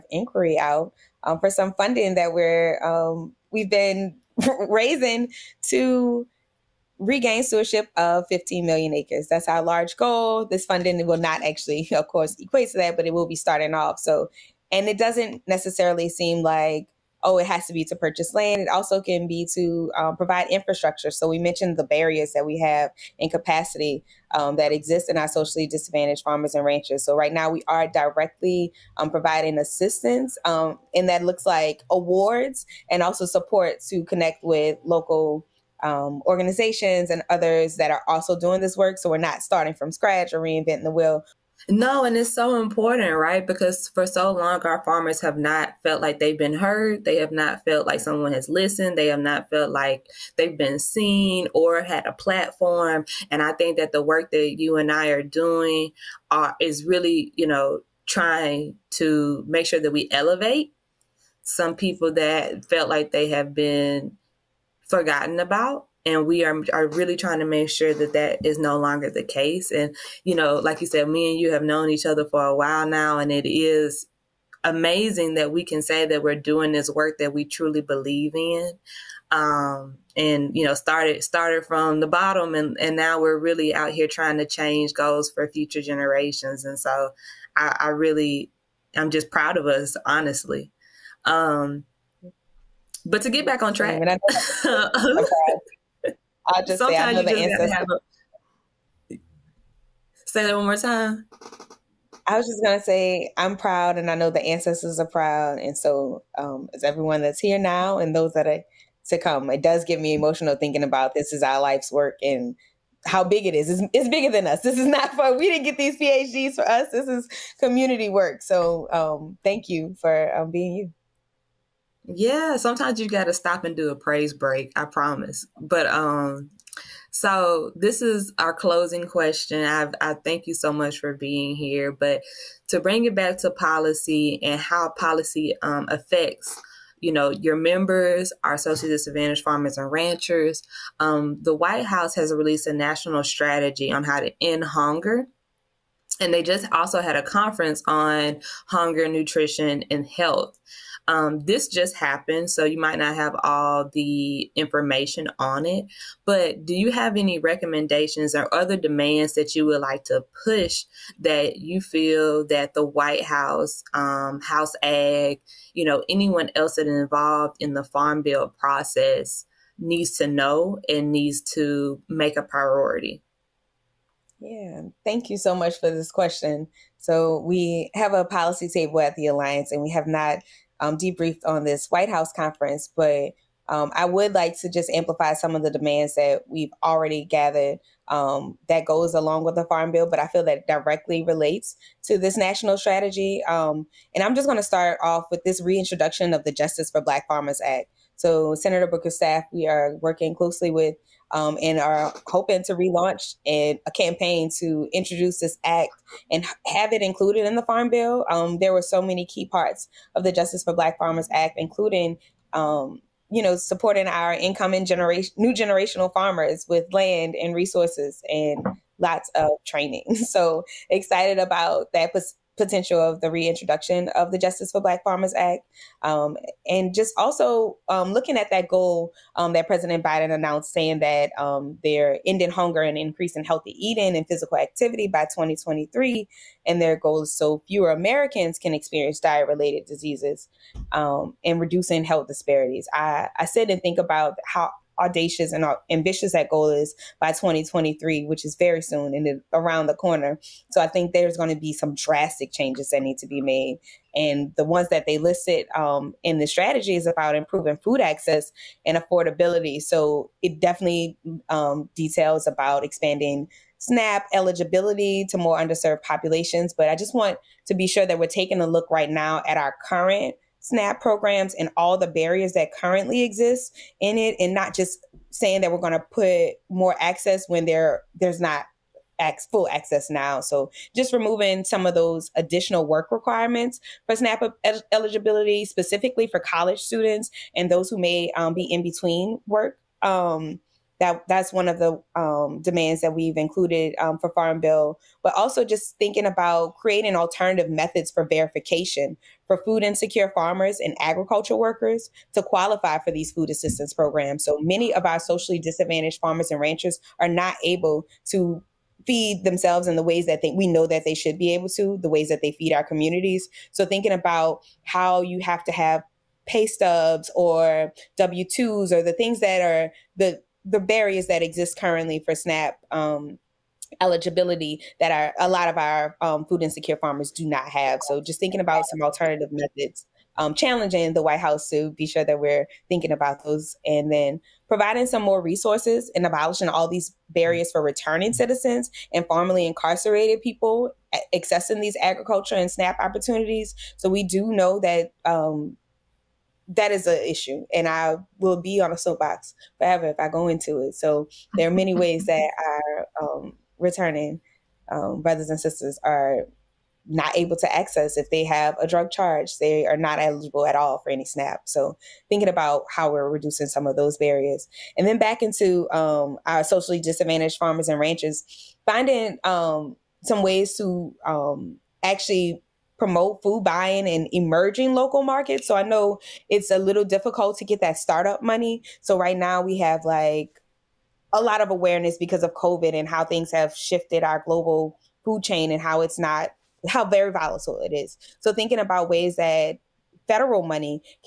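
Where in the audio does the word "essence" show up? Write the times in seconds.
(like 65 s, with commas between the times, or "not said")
not said.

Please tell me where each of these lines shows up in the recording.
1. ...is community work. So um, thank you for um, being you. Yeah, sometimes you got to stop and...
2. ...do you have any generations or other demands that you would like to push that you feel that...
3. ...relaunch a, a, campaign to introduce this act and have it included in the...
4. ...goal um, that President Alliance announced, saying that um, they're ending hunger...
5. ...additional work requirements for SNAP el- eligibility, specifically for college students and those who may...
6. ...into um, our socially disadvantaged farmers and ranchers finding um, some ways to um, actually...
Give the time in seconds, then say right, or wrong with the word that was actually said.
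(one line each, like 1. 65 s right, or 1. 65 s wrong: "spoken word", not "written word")
1. 117 s right
2. 156 s wrong: "recommendations", not "generations"
3. 202 s right
4. 228 s wrong: "Biden", not "Alliance"
5. 282 s right
6. 365 s right.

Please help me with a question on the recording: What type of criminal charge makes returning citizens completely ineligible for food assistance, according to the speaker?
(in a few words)
drug charge.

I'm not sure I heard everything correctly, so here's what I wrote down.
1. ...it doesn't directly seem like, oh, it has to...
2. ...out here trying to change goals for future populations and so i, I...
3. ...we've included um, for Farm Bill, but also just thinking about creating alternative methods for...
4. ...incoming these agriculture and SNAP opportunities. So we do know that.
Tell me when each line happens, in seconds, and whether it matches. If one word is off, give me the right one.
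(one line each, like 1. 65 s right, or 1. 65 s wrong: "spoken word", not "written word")
1. 14 s wrong: "necessarily", not "directly"
2. 83 s wrong: "generations", not "populations"
3. 293 s right
4. 341 s wrong: "accessing", not "incoming".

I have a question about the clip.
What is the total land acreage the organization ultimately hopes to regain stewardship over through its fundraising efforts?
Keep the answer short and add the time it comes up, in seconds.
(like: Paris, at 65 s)
15 million acres, at 8 s.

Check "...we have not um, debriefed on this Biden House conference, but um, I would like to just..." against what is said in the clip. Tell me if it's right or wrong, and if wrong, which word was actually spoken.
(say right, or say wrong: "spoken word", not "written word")
wrong: "White", not "Biden".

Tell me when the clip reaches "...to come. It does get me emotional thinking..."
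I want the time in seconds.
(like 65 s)
109 s.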